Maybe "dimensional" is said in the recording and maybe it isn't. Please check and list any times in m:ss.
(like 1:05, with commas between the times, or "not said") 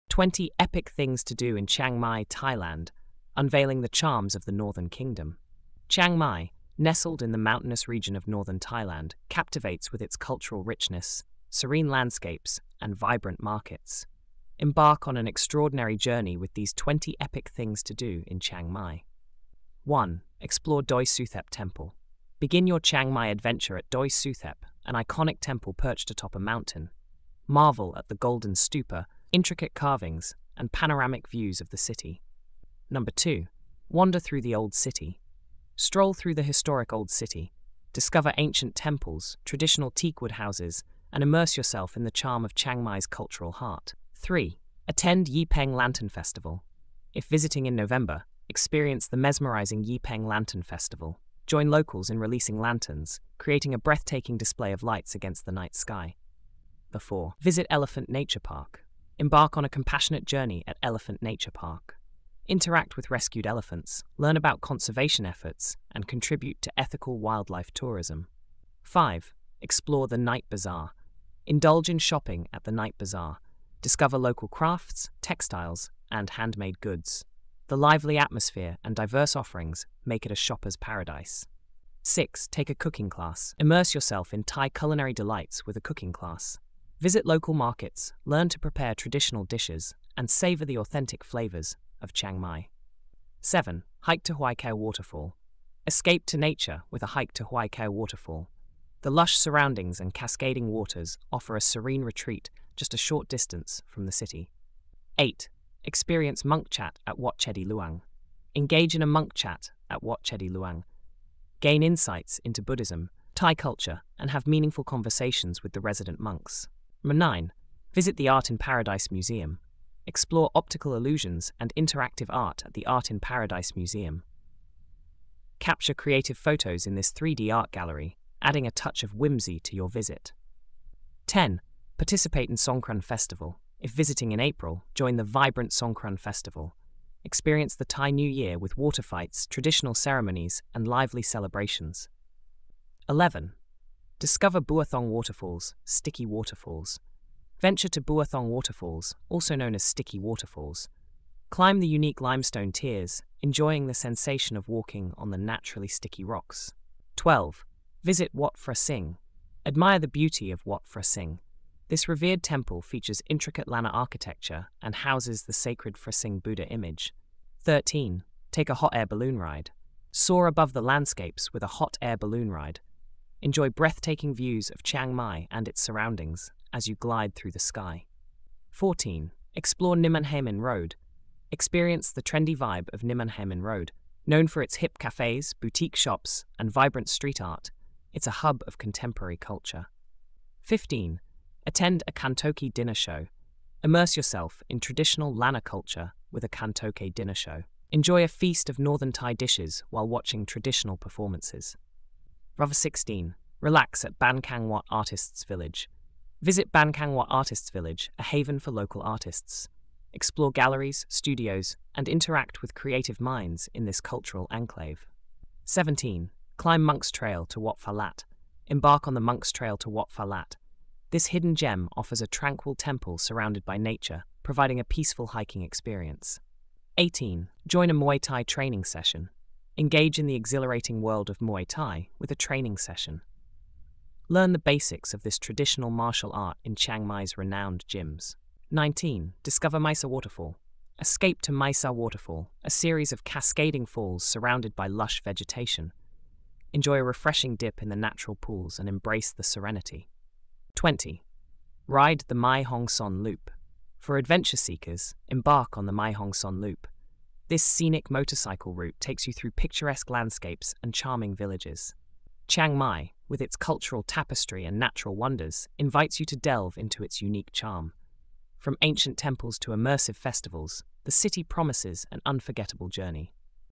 not said.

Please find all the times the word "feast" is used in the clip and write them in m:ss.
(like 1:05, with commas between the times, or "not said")
3:18.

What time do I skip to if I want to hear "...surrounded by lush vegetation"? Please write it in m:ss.
4:04.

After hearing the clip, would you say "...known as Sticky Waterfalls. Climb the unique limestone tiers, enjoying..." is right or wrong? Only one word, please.
right.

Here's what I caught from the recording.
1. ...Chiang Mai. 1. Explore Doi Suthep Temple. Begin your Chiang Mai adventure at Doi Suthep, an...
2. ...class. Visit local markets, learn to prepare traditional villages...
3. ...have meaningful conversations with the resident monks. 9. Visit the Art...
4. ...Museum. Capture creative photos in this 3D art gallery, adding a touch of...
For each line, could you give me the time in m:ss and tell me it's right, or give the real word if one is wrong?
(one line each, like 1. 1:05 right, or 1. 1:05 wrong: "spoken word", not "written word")
1. 0:18 right
2. 1:26 wrong: "dishes", not "villages"
3. 1:54 right
4. 2:03 right.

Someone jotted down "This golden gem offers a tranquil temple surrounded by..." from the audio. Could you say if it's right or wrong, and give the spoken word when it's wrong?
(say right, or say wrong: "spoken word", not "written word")
wrong: "hidden", not "golden".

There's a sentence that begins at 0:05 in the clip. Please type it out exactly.
Chiang Mai, nestled in the mountainous region of northern Thailand, captivates with its cultural richness, serene landscapes, and vibrant markets.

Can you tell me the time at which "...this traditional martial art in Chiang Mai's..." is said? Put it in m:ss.
3:55.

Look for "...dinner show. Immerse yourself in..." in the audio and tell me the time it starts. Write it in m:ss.
3:12.